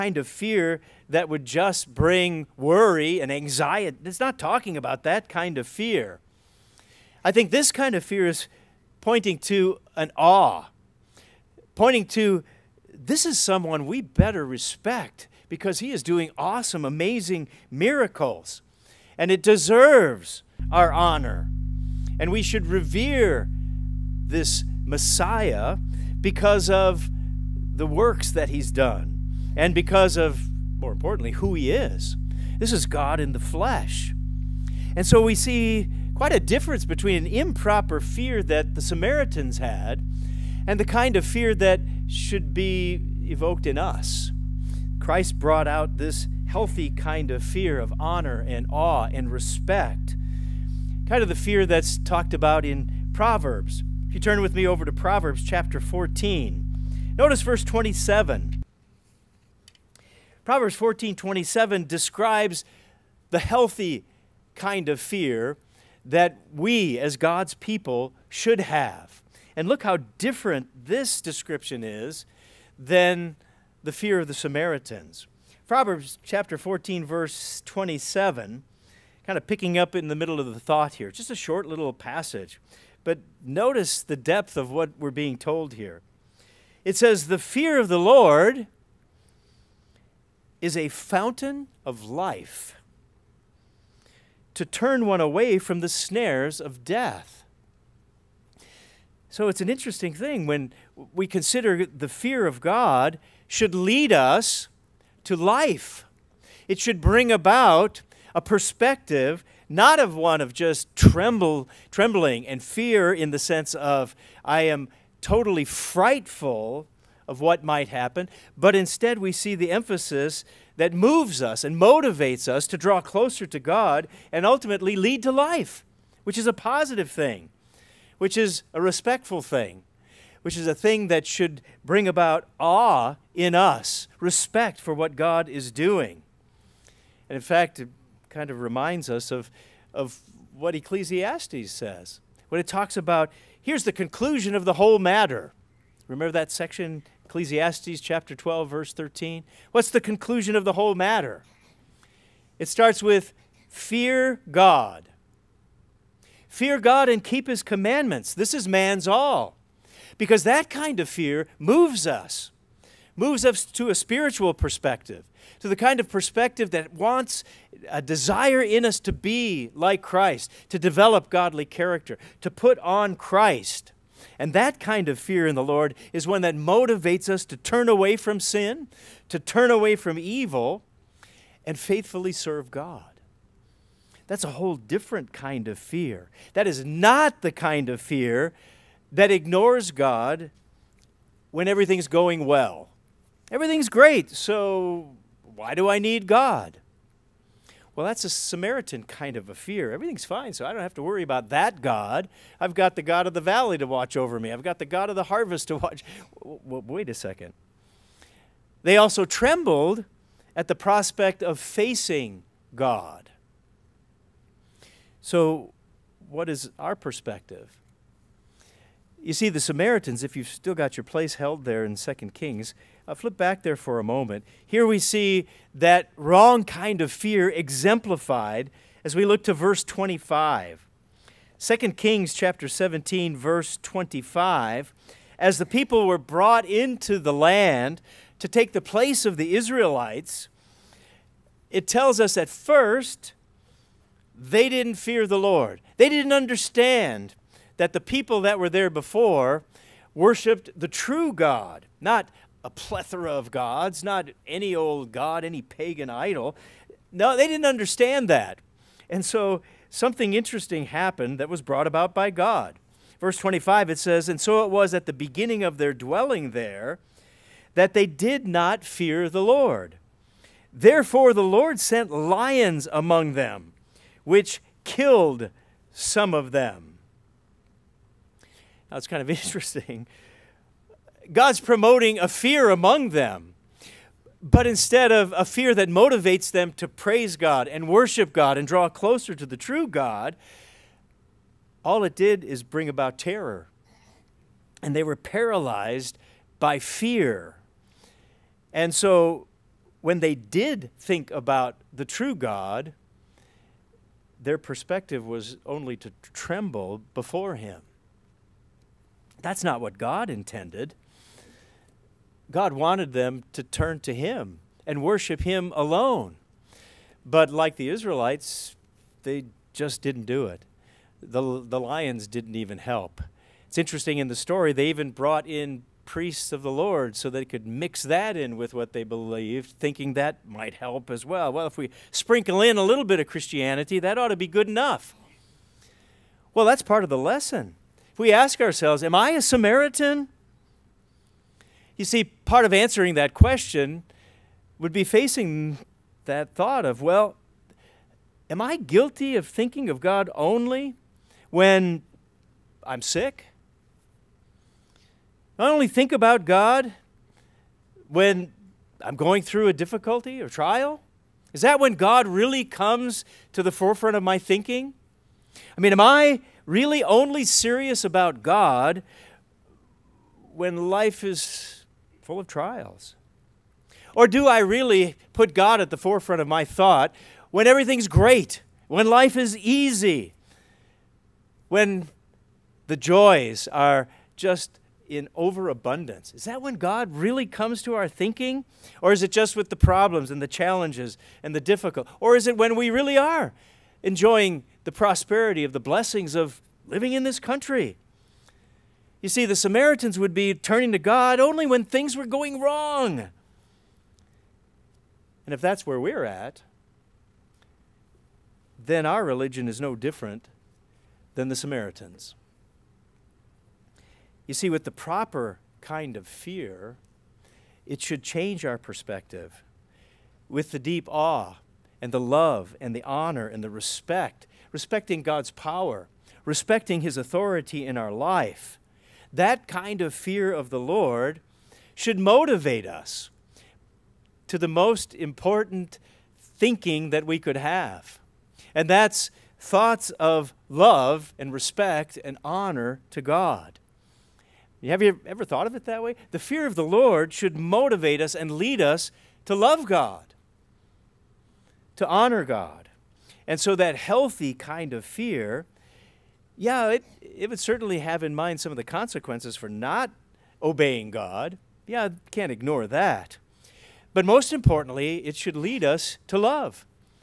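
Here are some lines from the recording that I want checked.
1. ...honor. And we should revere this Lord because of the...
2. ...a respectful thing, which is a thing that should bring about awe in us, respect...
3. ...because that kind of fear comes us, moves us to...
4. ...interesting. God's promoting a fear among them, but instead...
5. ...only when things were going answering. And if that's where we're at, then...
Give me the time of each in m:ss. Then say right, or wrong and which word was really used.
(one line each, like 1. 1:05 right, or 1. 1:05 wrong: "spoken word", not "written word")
1. 0:20 wrong: "Messiah", not "Lord"
2. 2:08 right
3. 2:40 wrong: "moves", not "comes"
4. 4:39 right
5. 6:41 wrong: "wrong", not "answering".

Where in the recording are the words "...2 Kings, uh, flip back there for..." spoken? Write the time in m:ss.
3:41.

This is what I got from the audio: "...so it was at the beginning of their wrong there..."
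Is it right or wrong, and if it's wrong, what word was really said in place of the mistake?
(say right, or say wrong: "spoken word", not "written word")
wrong: "dwelling", not "wrong".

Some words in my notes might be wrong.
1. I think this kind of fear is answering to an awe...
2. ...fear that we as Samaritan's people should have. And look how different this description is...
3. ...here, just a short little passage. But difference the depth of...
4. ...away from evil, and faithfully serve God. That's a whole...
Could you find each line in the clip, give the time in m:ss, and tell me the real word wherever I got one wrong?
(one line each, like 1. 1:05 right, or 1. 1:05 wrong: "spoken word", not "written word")
1. 0:07 wrong: "pointing", not "answering"
2. 1:04 wrong: "God", not "Samaritan"
3. 1:20 wrong: "notice", not "difference"
4. 2:59 right.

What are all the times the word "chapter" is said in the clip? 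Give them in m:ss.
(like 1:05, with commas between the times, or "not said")
0:55, 1:16, 2:28, 3:52.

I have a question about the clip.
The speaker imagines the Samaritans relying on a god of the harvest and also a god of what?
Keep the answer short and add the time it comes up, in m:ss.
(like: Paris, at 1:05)
The valley, at 3:23.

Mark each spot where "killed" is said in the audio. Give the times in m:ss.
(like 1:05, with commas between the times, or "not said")
4:34.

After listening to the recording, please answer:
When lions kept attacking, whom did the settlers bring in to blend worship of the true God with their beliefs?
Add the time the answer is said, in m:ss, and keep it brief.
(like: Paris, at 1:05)
Priests of the Lord, at 5:26.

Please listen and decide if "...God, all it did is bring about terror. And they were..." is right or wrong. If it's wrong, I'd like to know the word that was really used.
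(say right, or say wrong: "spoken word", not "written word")
right.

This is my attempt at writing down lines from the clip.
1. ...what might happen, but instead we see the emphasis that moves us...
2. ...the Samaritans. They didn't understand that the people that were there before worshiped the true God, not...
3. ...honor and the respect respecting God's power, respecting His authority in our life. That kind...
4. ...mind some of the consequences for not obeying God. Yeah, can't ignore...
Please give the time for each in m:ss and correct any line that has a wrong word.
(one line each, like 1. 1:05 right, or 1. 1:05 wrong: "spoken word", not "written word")
1. 1:57 right
2. 4:05 wrong: "Lord", not "Samaritans"
3. 7:03 right
4. 7:38 right.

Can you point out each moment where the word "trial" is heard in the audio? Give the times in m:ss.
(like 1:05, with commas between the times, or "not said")
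6:00, 6:12.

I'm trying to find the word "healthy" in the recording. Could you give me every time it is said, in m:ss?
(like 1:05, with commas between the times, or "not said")
0:46, 1:03, 7:33.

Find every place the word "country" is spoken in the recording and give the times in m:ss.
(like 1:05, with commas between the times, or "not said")
6:37.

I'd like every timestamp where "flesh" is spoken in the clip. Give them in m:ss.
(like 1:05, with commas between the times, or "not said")
0:33.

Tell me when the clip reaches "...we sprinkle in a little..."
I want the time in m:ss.
5:31.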